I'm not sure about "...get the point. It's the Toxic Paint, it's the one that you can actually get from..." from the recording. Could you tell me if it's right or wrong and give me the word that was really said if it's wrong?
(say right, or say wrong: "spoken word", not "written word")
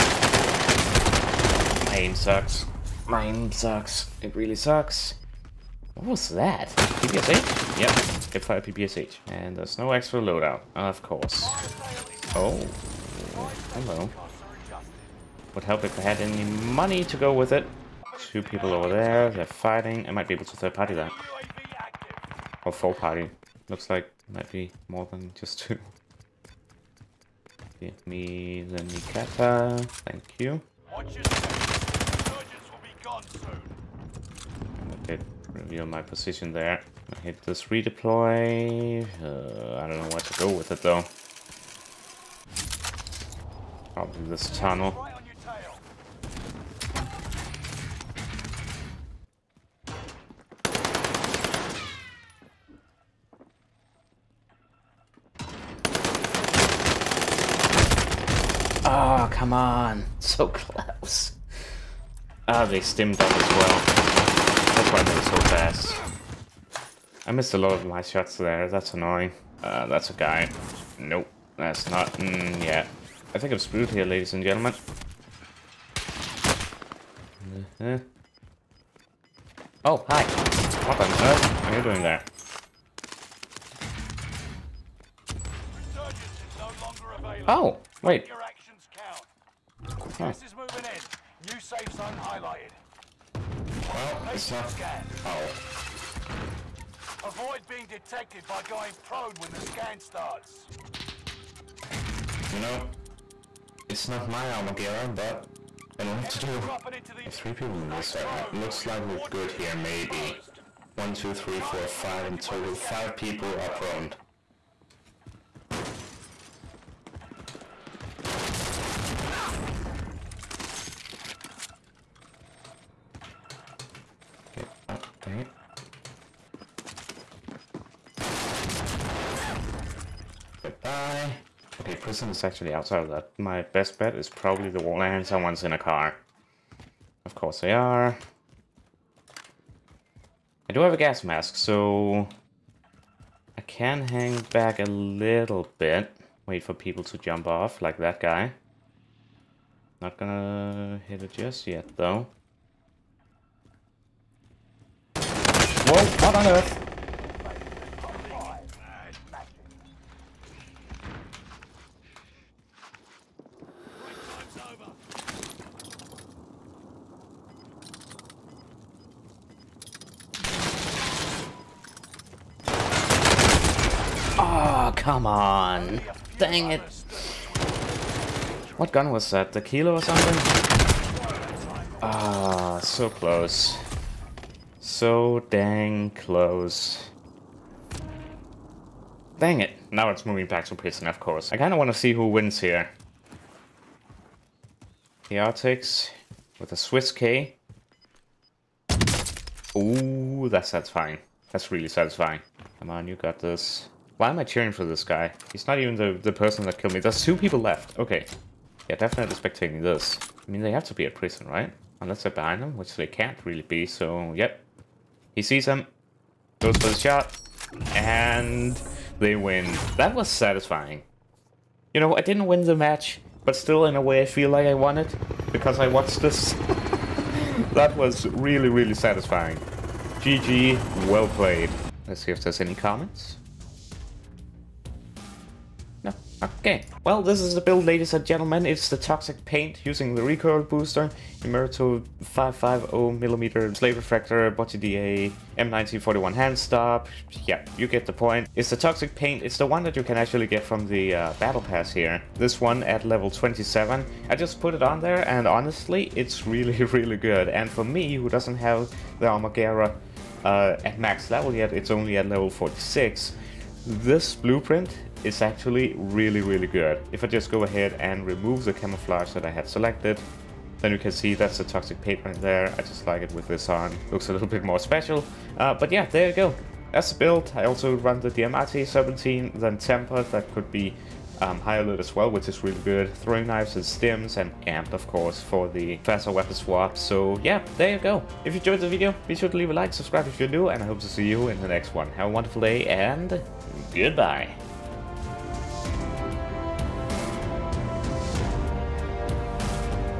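right.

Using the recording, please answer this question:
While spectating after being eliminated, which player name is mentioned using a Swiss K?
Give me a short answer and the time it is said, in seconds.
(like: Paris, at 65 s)
Chaotix, at 195 s.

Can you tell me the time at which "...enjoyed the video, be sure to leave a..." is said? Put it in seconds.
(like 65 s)
288 s.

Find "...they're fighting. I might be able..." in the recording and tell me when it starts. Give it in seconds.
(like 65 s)
19 s.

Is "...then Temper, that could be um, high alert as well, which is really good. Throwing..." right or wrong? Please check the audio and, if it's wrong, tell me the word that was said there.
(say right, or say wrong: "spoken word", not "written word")
right.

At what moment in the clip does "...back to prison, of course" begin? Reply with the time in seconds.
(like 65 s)
190 s.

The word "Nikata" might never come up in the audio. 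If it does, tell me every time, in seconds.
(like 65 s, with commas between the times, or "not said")
28 s.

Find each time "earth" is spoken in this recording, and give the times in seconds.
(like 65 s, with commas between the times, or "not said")
81 s, 156 s.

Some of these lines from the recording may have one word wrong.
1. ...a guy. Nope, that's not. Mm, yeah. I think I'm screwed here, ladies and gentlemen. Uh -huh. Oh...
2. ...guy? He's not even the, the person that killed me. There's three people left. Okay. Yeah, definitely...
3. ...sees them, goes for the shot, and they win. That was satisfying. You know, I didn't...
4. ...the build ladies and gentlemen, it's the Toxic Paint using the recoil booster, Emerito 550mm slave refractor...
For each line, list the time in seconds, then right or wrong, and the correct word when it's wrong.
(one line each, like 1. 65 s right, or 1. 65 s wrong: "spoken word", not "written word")
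1. 70 s right
2. 205 s wrong: "two", not "three"
3. 215 s right
4. 237 s right.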